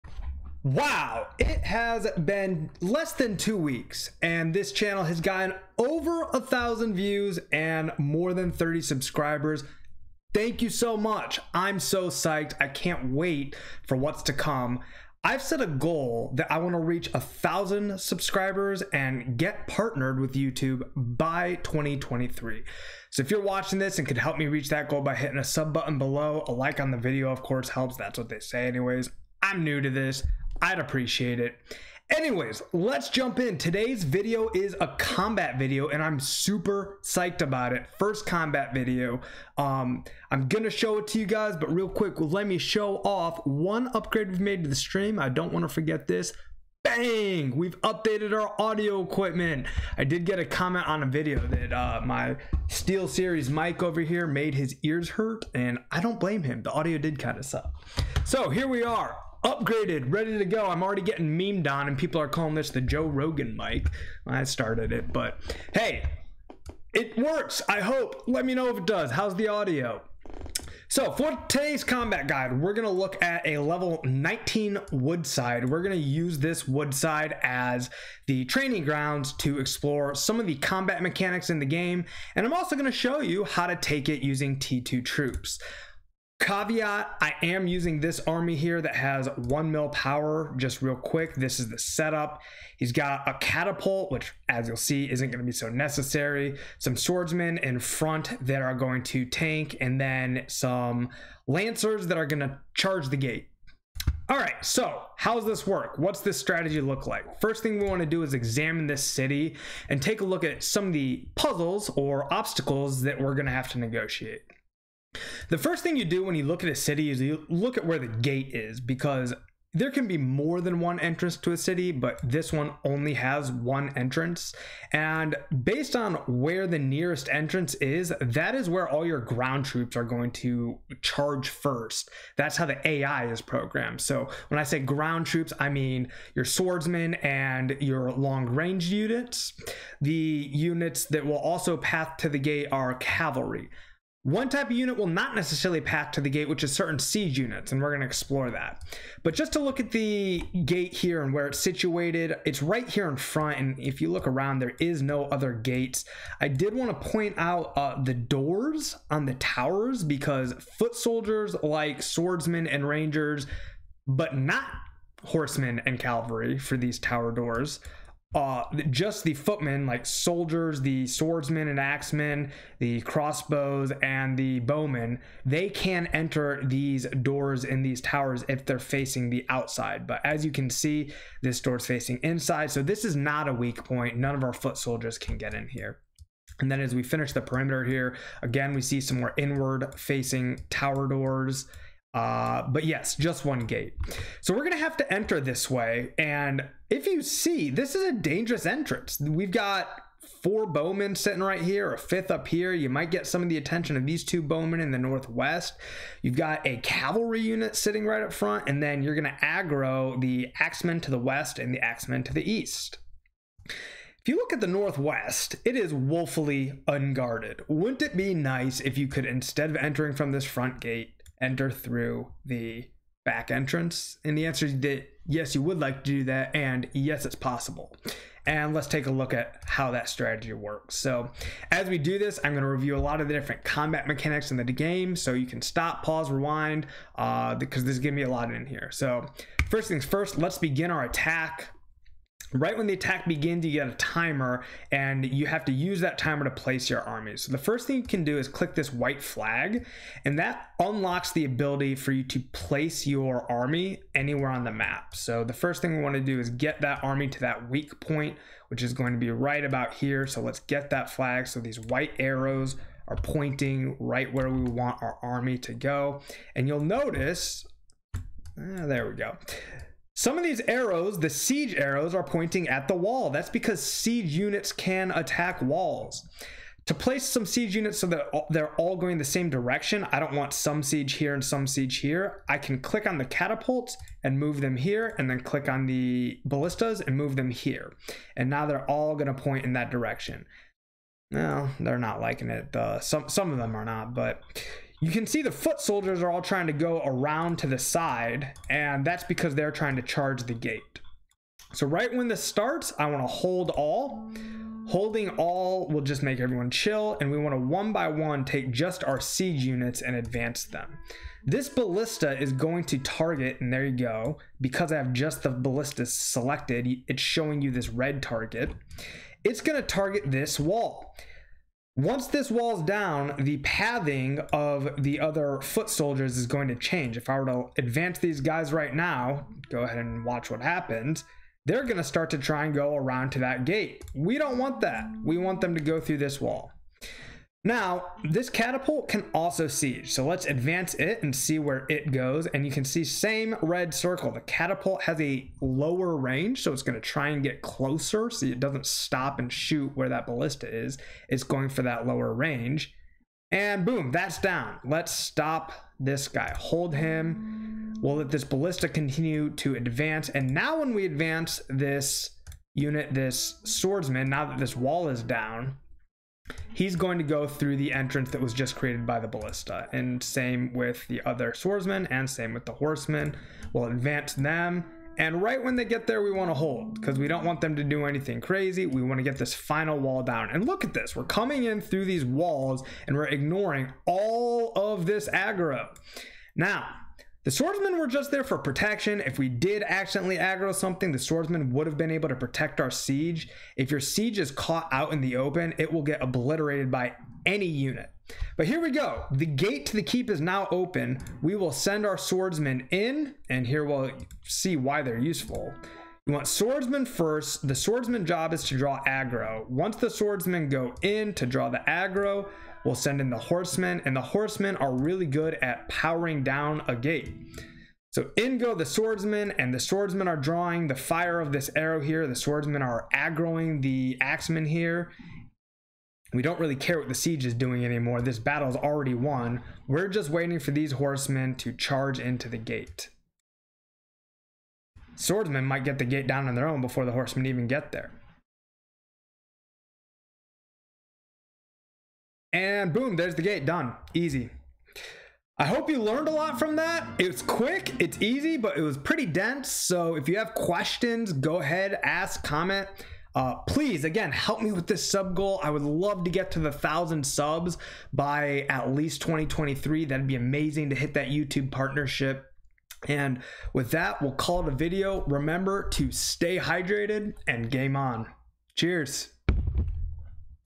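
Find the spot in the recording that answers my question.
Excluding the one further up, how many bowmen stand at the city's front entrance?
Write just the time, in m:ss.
3:20.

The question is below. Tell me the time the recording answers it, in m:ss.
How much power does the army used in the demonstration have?
1:29.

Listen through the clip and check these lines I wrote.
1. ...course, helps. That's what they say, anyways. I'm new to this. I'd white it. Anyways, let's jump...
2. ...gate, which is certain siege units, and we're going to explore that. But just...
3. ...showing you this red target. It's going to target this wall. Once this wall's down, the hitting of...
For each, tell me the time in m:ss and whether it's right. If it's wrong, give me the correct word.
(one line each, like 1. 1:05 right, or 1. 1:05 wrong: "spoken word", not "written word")
1. 0:27 wrong: "appreciate", not "white"
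2. 2:26 right
3. 5:17 wrong: "pathing", not "hitting".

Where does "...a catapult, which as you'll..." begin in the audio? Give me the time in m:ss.
1:33.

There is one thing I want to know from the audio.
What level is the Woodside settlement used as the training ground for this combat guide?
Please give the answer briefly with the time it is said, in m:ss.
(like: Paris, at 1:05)
19, at 1:13.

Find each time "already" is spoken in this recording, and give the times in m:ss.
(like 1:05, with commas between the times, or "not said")
1:00, 7:08.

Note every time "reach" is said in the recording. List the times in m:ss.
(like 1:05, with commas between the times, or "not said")
0:16, 0:24.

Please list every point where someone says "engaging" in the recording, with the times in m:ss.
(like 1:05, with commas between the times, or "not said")
not said.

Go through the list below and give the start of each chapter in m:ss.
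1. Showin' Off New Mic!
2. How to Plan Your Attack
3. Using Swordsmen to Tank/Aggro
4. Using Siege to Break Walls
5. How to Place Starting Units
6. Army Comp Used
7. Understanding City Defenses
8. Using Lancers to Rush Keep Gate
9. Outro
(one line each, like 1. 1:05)
1. 0:40
2. 3:14
3. 6:40
4. 5:00
5. 4:00
6. 1:10
7. 1:47
8. 7:10
9. 7:25.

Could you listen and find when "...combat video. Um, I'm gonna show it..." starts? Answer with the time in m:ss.
0:38.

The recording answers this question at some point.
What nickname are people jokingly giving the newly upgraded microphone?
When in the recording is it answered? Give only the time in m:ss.
1:02.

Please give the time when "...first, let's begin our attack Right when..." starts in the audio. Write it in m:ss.
4:00.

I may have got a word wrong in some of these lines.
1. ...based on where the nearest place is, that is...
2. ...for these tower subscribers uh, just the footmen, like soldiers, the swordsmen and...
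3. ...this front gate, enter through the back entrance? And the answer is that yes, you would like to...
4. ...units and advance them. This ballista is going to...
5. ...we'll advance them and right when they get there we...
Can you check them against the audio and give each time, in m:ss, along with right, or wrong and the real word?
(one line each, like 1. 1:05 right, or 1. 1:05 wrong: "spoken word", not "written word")
1. 2:05 wrong: "entrance", not "place"
2. 2:46 wrong: "doors", not "subscribers"
3. 3:40 right
4. 5:09 right
5. 6:13 right.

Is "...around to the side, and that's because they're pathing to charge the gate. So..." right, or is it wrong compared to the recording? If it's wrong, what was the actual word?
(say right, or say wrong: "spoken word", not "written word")
wrong: "trying", not "pathing".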